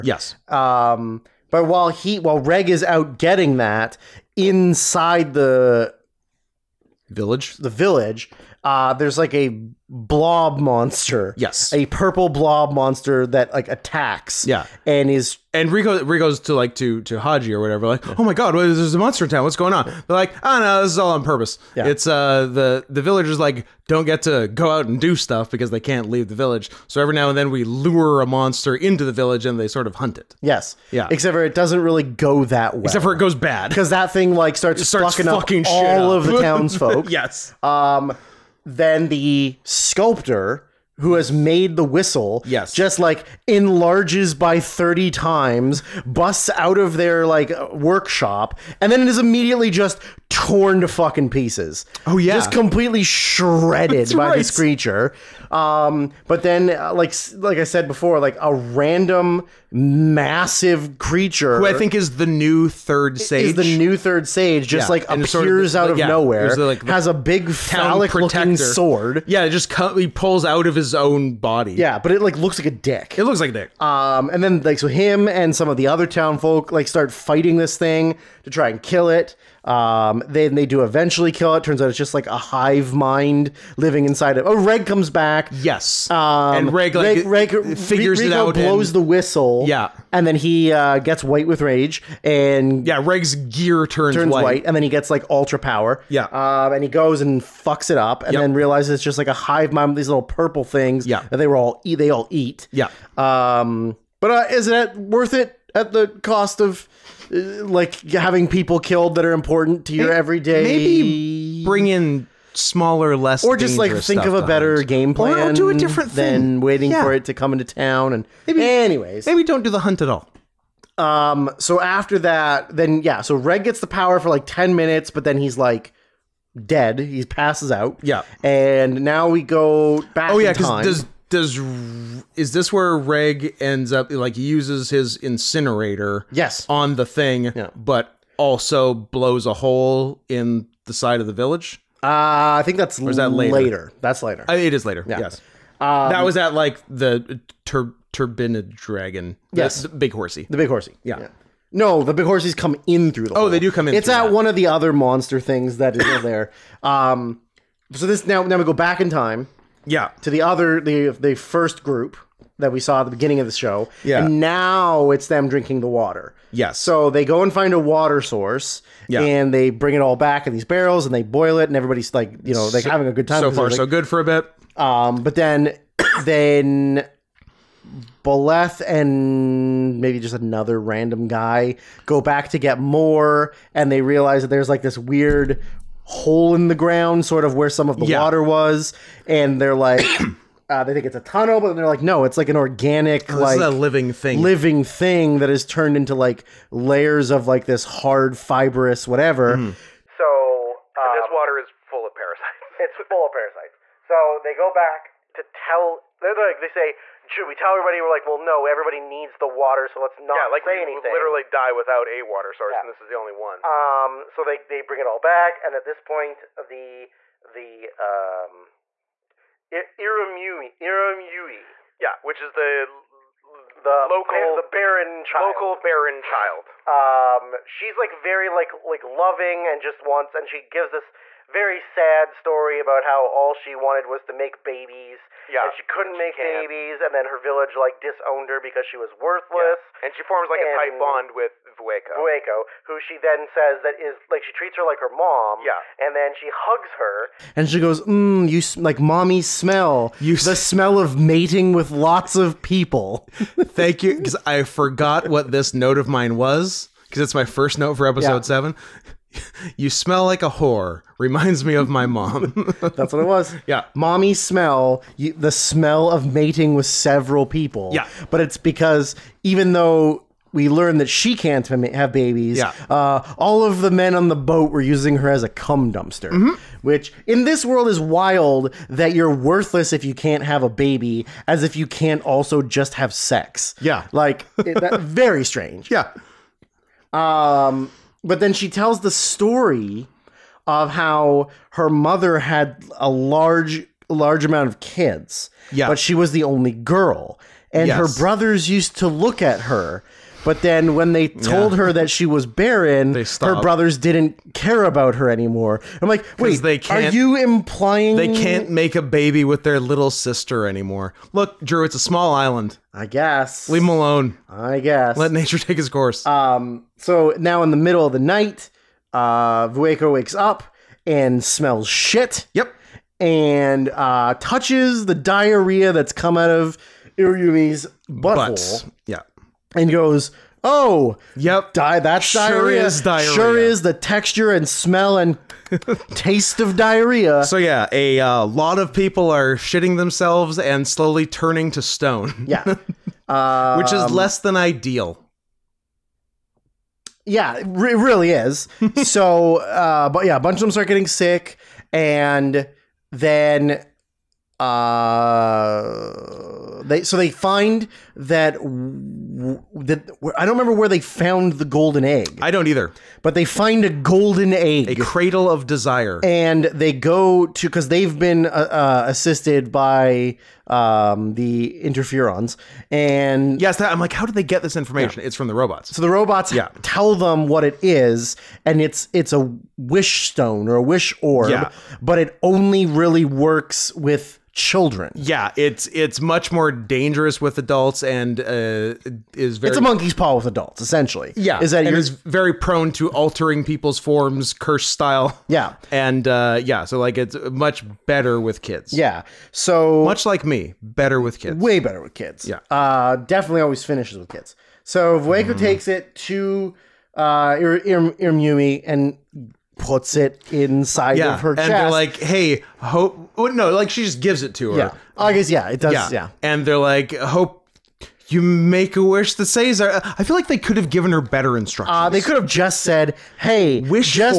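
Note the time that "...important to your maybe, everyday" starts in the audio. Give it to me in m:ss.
1:49.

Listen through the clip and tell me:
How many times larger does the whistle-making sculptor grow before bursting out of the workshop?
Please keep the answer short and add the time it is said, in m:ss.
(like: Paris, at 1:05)
30, at 0:44.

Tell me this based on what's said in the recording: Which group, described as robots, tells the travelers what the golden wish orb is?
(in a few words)
The interferons.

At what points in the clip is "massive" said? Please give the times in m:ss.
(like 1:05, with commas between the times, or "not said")
0:59.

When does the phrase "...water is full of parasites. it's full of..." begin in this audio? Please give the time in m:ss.
3:21.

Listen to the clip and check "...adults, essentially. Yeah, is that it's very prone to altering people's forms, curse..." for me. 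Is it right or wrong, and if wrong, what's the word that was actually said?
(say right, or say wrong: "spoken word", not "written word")
right.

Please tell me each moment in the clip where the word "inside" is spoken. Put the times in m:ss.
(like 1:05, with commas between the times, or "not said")
0:04, 1:24, 6:50.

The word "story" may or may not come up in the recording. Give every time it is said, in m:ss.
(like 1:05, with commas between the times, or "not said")
3:52, 4:49.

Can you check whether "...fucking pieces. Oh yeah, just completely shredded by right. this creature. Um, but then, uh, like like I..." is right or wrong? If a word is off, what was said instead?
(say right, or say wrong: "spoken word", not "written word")
right.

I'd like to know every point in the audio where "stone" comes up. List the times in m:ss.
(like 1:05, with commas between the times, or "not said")
5:41, 6:20.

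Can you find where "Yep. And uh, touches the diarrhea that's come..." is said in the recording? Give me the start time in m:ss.
5:22.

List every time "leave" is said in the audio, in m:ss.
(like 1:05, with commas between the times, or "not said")
0:26, 5:13.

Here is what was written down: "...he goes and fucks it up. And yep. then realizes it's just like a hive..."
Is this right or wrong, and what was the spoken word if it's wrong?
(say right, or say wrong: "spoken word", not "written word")
right.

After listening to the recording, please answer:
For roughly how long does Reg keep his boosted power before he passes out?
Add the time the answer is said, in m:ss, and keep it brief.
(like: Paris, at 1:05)
Ten minutes, at 2:04.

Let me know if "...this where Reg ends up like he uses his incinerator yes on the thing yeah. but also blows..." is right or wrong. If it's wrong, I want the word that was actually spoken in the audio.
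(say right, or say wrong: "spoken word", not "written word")
right.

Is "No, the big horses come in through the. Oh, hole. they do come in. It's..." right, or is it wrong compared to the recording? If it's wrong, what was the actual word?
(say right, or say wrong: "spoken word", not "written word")
right.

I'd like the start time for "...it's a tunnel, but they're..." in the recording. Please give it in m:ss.
3:11.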